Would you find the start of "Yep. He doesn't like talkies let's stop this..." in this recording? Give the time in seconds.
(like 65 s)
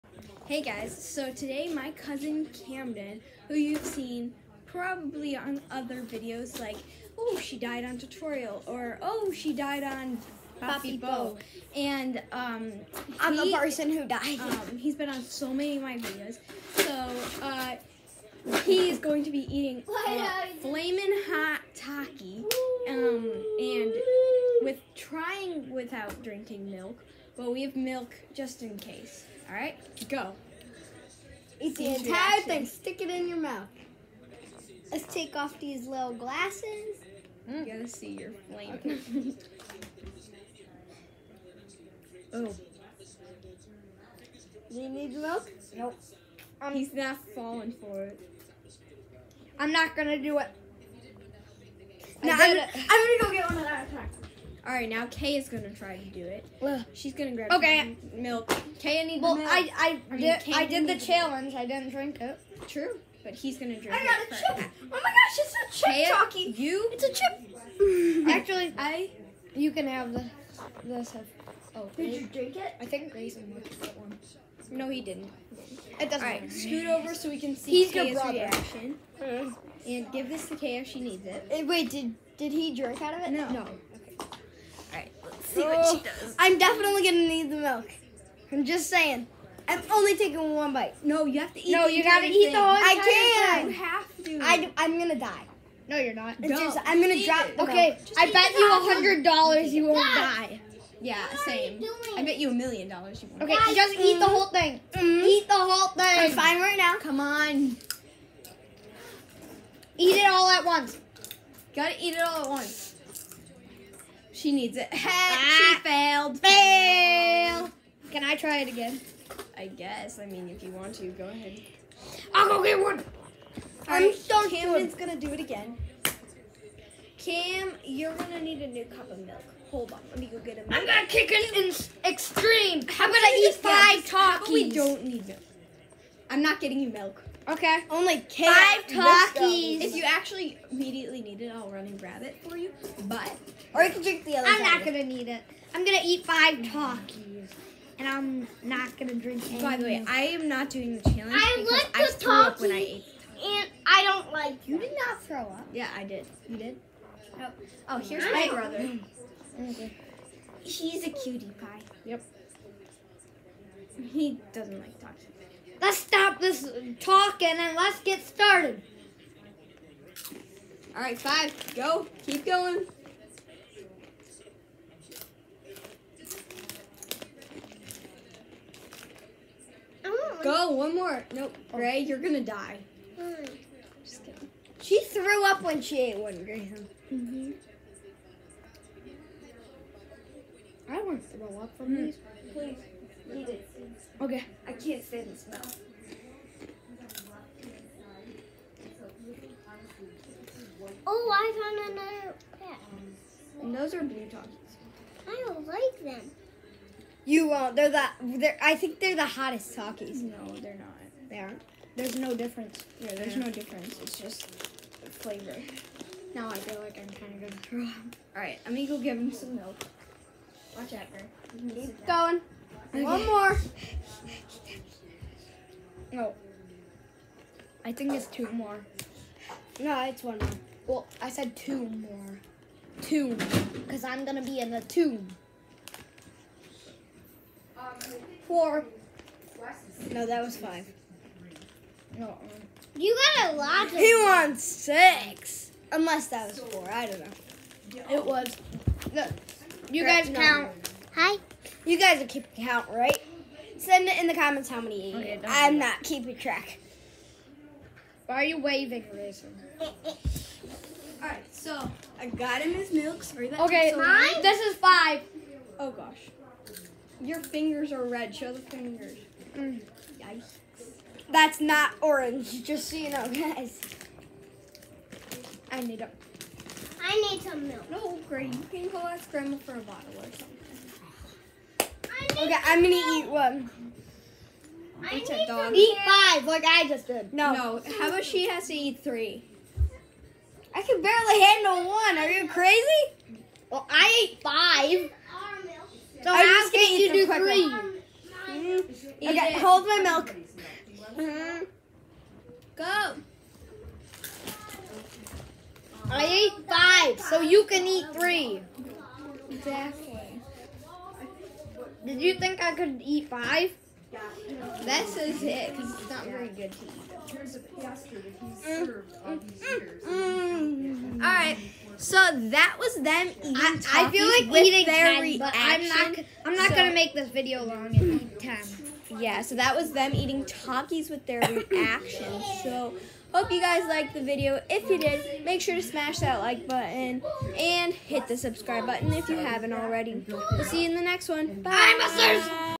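162 s.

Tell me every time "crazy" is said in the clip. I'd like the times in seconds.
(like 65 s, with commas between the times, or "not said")
292 s.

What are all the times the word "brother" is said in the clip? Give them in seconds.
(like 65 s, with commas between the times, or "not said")
78 s, 158 s.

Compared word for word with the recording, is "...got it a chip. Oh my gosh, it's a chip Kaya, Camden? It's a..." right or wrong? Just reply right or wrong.
wrong.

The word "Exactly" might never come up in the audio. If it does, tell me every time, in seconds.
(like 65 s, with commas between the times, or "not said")
309 s.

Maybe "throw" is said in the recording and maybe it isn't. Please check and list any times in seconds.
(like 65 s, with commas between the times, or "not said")
155 s, 191 s, 217 s.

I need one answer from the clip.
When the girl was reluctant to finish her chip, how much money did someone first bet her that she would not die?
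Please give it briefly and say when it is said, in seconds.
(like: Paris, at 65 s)
$100, at 98 s.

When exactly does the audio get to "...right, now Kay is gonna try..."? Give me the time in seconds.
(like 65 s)
54 s.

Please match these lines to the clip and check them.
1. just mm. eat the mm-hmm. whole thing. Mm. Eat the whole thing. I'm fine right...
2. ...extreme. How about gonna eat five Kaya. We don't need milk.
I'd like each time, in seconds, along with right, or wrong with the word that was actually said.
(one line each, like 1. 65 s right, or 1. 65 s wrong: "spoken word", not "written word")
1. 103 s right
2. 132 s wrong: "Takis", not "Kaya".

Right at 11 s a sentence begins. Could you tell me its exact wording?
And um, I'm the person who died.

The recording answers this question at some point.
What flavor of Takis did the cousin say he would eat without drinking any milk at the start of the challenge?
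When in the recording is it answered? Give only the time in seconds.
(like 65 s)
20 s.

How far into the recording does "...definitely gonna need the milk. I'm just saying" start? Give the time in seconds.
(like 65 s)
86 s.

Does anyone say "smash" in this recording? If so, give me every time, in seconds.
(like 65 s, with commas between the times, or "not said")
335 s.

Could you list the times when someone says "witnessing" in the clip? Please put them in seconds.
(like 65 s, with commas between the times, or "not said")
not said.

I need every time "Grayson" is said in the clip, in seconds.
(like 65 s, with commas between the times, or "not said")
73 s, 259 s.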